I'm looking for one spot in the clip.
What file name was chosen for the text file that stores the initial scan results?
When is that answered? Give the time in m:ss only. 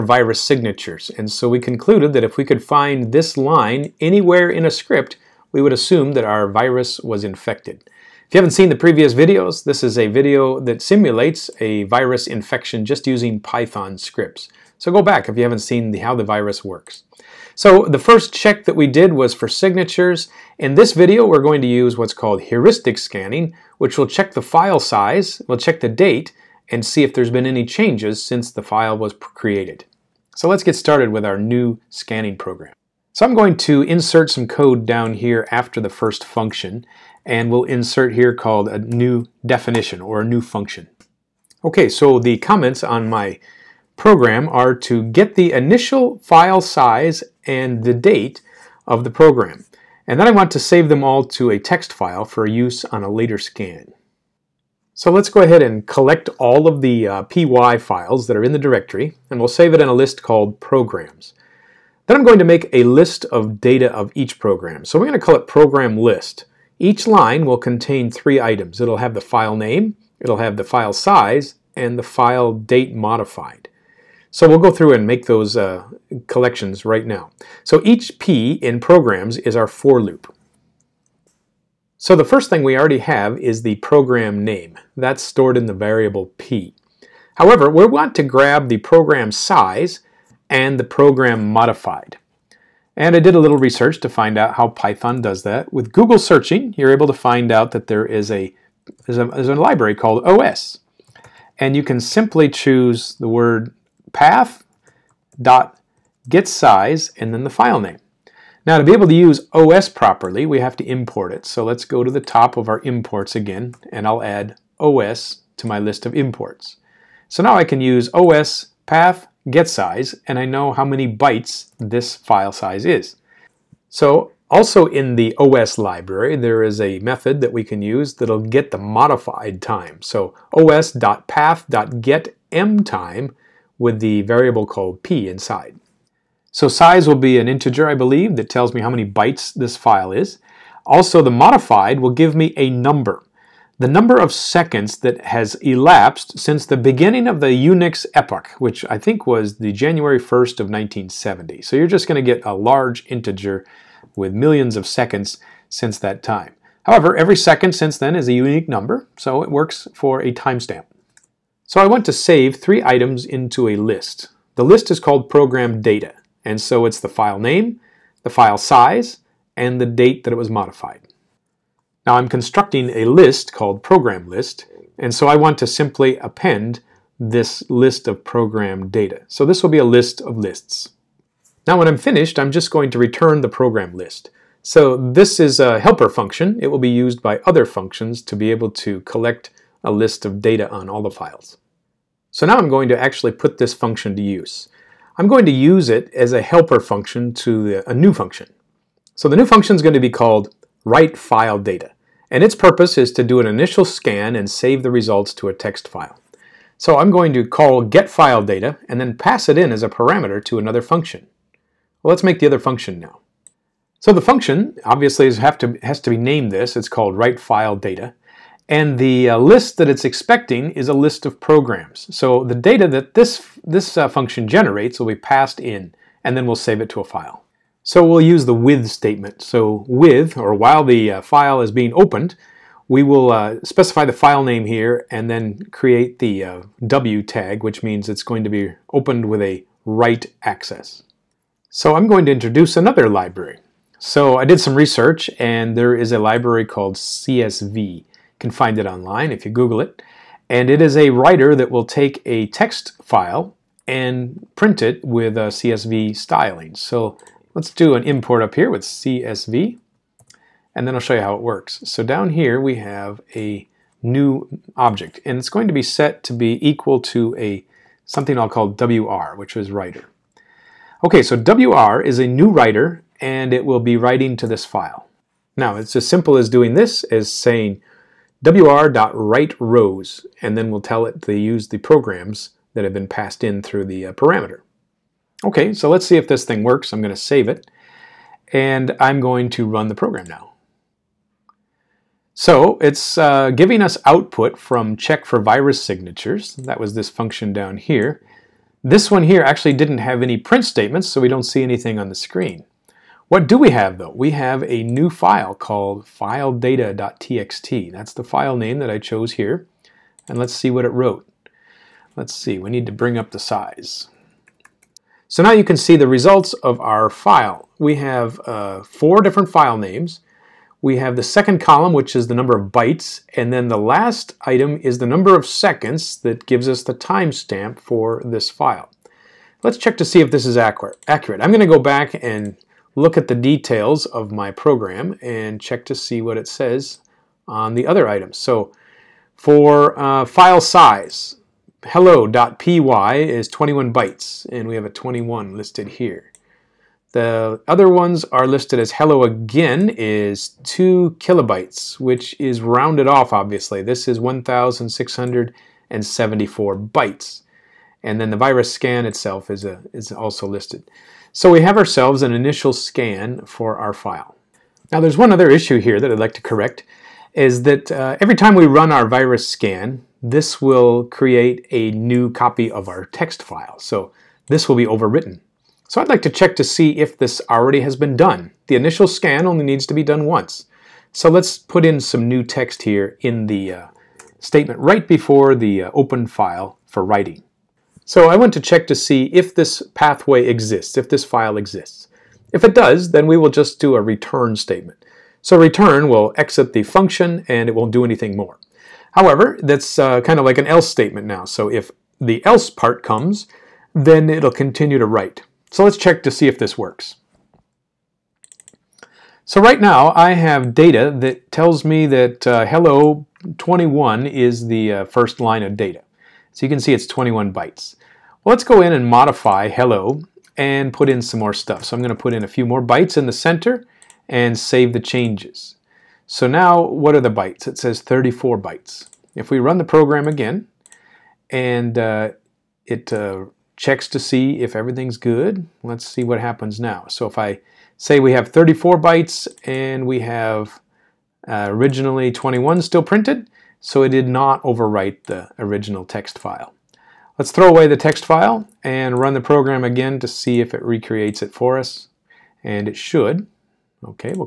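5:06.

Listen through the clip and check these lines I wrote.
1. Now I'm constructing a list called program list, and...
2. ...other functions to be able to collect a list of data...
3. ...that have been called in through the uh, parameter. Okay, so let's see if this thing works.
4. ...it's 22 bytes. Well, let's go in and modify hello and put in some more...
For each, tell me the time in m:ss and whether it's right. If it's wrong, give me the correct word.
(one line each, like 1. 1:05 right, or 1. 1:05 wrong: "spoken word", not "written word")
1. 2:52 right
2. 3:07 right
3. 4:42 wrong: "passed", not "called"
4. 6:56 wrong: "21", not "22".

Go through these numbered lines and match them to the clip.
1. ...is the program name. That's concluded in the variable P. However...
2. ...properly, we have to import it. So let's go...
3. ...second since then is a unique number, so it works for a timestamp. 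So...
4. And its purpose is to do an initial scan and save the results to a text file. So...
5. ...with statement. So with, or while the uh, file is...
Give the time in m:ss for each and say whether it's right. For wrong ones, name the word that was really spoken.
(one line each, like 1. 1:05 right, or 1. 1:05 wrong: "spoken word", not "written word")
1. 1:23 wrong: "stored", not "concluded"
2. 1:49 right
3. 2:37 right
4. 3:22 right
5. 3:48 right.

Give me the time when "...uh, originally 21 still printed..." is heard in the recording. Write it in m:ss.
7:21.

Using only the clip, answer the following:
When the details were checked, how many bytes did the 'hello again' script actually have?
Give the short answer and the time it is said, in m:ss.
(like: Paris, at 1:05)
1674, at 5:54.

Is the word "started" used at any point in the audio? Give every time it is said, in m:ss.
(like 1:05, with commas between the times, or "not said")
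0:30.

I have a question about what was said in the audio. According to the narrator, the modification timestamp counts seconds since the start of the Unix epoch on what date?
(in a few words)
January 1st of 1970.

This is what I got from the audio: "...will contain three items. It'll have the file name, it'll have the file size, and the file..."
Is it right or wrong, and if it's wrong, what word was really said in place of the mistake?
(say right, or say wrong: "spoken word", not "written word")
right.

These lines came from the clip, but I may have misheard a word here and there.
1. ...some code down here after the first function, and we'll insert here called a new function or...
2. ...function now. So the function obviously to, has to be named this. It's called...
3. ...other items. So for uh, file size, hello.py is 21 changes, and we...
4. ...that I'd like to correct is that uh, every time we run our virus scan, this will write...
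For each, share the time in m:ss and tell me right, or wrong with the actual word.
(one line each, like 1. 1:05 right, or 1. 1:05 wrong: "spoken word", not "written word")
1. 0:34 wrong: "definition", not "function"
2. 3:32 right
3. 5:37 wrong: "bytes", not "changes"
4. 6:06 wrong: "create", not "write".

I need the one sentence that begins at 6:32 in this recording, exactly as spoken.
If it does, then we will just do a return statement.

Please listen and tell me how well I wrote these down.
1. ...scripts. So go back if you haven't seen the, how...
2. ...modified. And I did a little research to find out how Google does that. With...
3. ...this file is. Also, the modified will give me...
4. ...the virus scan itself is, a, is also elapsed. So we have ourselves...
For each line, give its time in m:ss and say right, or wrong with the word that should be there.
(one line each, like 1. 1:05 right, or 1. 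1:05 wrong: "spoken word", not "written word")
1. 0:13 right
2. 1:31 wrong: "Python", not "Google"
3. 2:19 right
4. 5:58 wrong: "listed", not "elapsed".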